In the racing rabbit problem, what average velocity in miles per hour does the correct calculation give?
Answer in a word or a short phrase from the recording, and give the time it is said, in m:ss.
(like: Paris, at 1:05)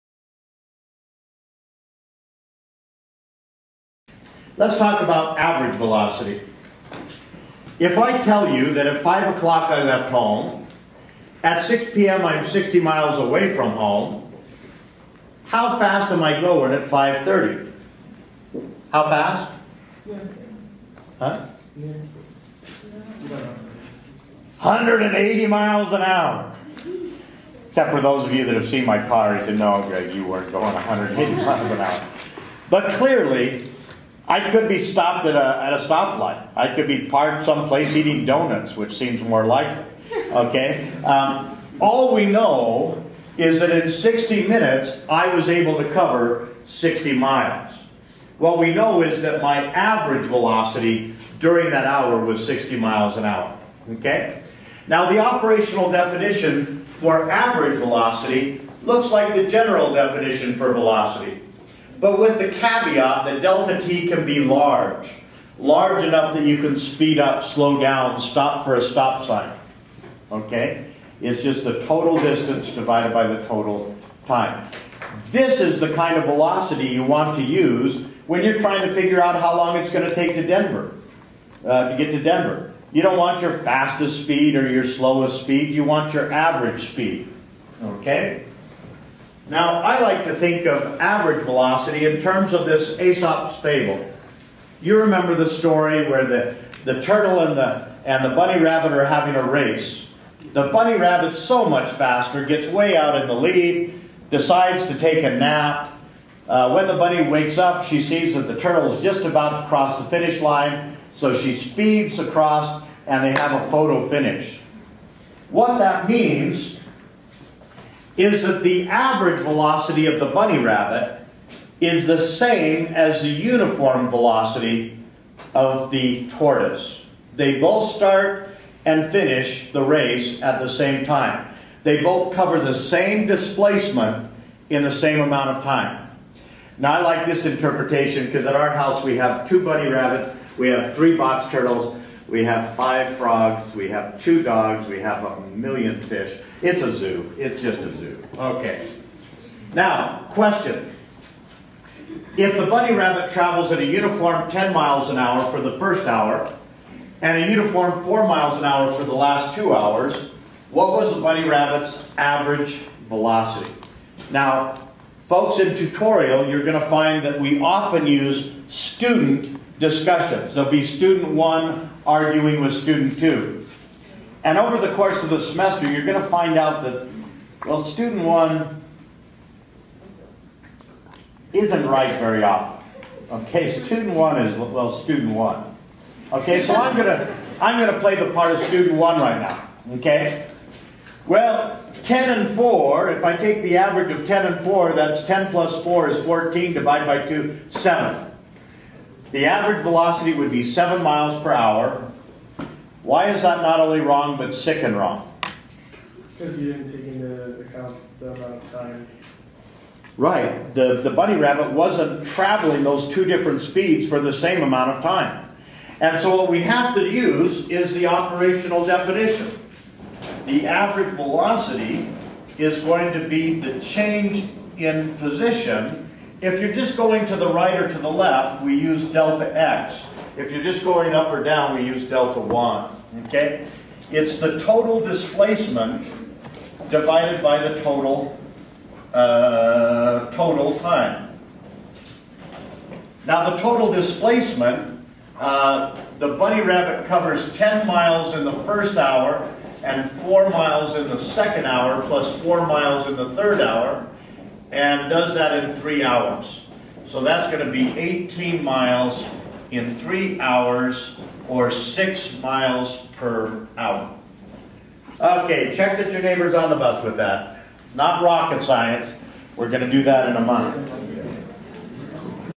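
6 miles per hour, at 4:21.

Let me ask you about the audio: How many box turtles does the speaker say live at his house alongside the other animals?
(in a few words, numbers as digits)
3.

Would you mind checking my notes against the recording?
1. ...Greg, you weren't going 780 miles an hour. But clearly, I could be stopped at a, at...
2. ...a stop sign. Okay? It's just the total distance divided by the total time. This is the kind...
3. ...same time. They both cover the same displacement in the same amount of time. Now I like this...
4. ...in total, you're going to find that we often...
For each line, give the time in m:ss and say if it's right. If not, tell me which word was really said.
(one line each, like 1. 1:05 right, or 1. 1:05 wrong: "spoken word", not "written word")
1. 0:29 wrong: "180", not "780"
2. 1:08 right
3. 2:10 right
4. 2:45 wrong: "tutorial", not "total".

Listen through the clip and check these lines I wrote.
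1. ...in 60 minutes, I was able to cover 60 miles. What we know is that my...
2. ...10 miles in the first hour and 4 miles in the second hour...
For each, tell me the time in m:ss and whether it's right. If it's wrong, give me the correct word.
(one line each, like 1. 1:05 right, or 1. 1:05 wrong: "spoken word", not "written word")
1. 0:43 right
2. 4:07 right.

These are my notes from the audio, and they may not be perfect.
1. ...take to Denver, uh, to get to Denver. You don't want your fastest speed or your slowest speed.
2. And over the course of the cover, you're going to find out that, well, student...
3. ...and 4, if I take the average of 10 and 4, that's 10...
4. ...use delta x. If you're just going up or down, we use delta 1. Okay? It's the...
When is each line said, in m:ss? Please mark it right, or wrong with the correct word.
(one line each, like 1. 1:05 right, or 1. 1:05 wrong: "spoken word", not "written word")
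1. 1:20 right
2. 2:54 wrong: "semester", not "cover"
3. 3:12 right
4. 3:48 right.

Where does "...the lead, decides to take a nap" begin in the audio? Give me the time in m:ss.
1:43.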